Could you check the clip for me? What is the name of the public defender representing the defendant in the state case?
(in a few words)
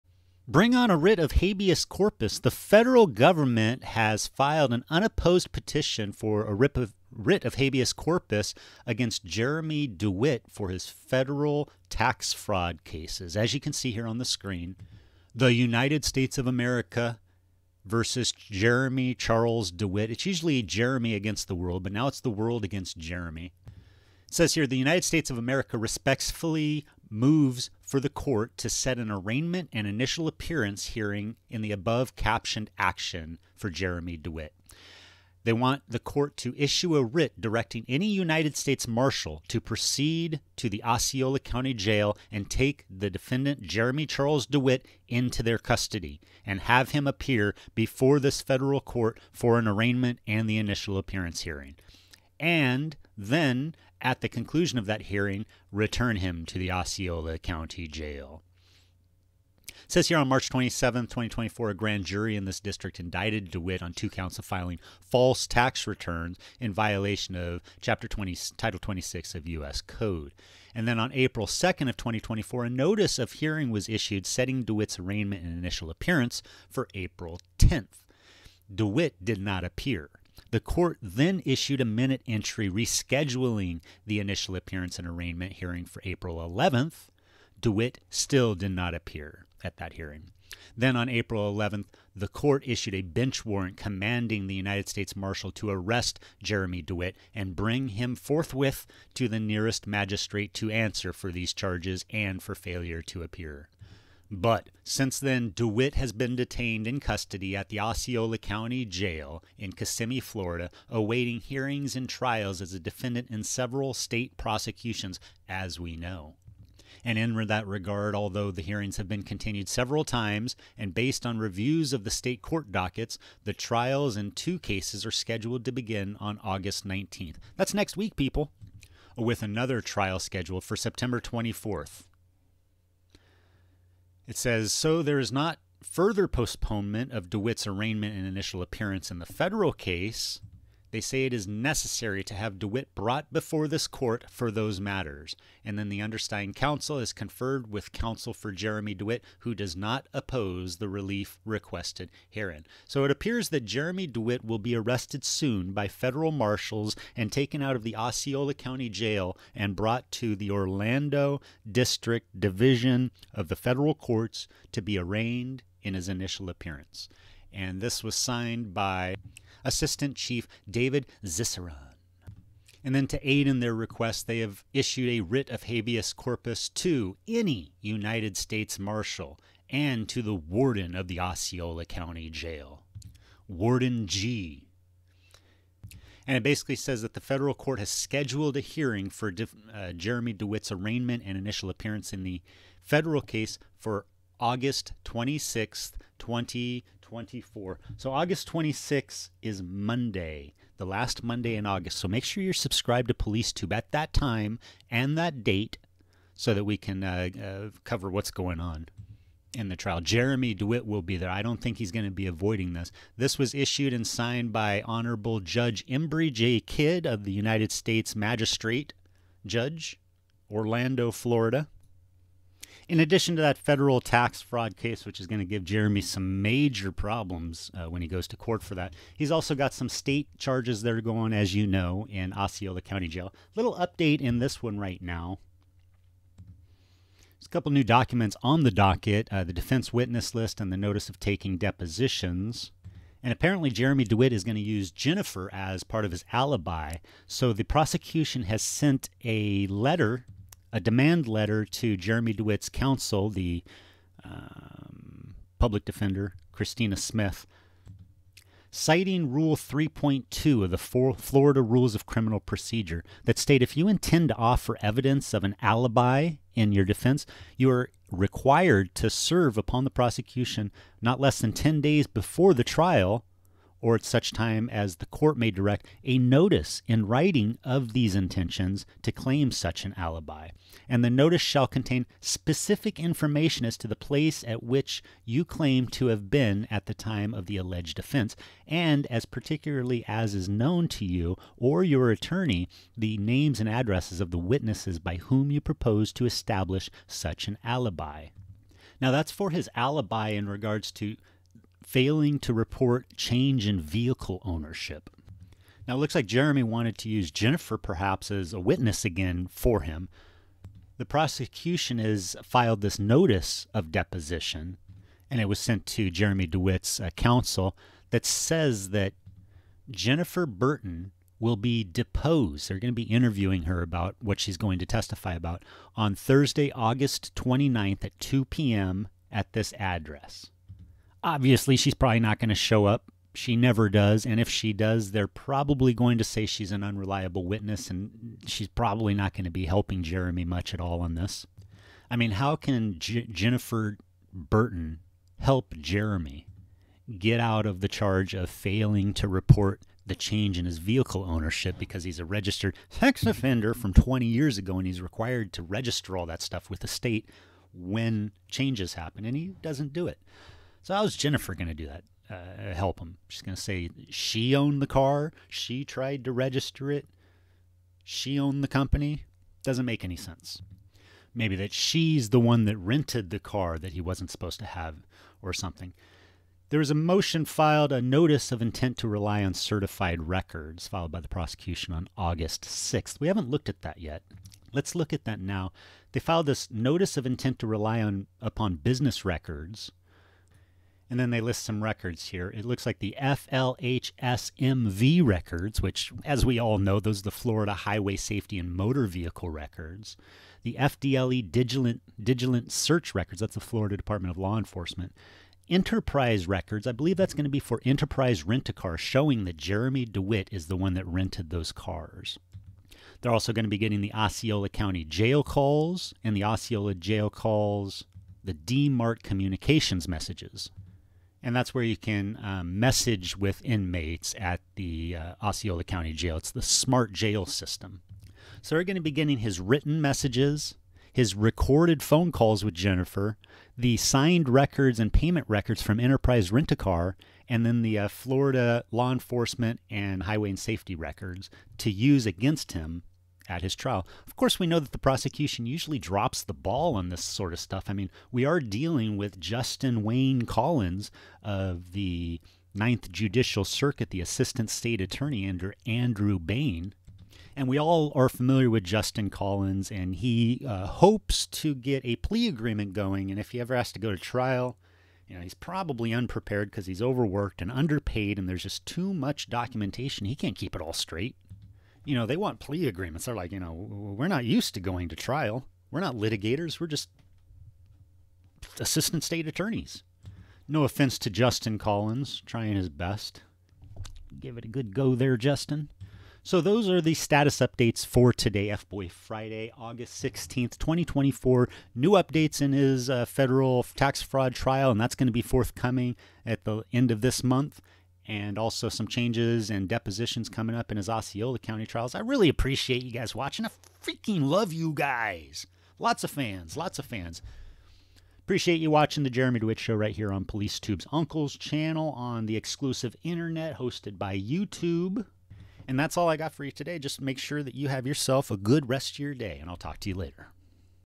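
Christina Smith.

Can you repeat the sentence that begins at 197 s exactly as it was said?
So August 26 is Monday, the last Monday in August.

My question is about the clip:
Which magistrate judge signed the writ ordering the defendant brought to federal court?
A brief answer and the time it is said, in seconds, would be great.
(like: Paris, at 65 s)
Embry J. Kidd, at 215 s.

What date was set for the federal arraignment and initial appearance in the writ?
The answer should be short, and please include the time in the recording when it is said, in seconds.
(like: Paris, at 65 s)
August 26th 2024, at 194 s.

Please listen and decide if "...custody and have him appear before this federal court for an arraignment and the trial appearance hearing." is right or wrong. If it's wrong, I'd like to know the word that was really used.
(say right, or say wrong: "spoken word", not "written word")
wrong: "initial", not "trial".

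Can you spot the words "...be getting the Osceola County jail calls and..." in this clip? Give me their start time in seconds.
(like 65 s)
413 s.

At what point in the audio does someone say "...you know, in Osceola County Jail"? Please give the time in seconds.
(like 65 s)
231 s.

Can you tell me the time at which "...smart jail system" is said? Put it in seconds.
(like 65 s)
426 s.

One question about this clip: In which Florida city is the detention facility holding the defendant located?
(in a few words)
Kissimmee.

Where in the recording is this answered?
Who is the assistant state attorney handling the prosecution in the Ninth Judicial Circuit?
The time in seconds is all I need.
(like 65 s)
449 s.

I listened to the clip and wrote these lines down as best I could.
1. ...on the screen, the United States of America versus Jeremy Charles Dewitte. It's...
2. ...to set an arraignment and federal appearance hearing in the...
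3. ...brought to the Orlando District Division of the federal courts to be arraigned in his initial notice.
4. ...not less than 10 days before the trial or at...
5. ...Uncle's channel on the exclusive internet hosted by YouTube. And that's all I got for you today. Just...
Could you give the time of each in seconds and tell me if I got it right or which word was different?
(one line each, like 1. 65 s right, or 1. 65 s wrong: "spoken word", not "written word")
1. 14 s right
2. 28 s wrong: "initial", not "federal"
3. 159 s wrong: "appearance", not "notice"
4. 271 s right
5. 511 s right.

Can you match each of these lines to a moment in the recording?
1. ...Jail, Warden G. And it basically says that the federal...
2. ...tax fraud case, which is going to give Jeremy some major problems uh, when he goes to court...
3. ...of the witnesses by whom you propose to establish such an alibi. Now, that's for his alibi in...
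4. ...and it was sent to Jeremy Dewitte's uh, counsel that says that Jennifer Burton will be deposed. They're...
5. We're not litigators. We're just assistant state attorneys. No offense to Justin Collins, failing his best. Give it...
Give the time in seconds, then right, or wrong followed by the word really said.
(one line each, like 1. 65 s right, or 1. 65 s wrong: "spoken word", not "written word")
1. 182 s right
2. 224 s right
3. 294 s right
4. 315 s right
5. 475 s wrong: "trying", not "failing".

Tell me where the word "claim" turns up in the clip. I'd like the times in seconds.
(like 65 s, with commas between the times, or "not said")
279 s, 285 s.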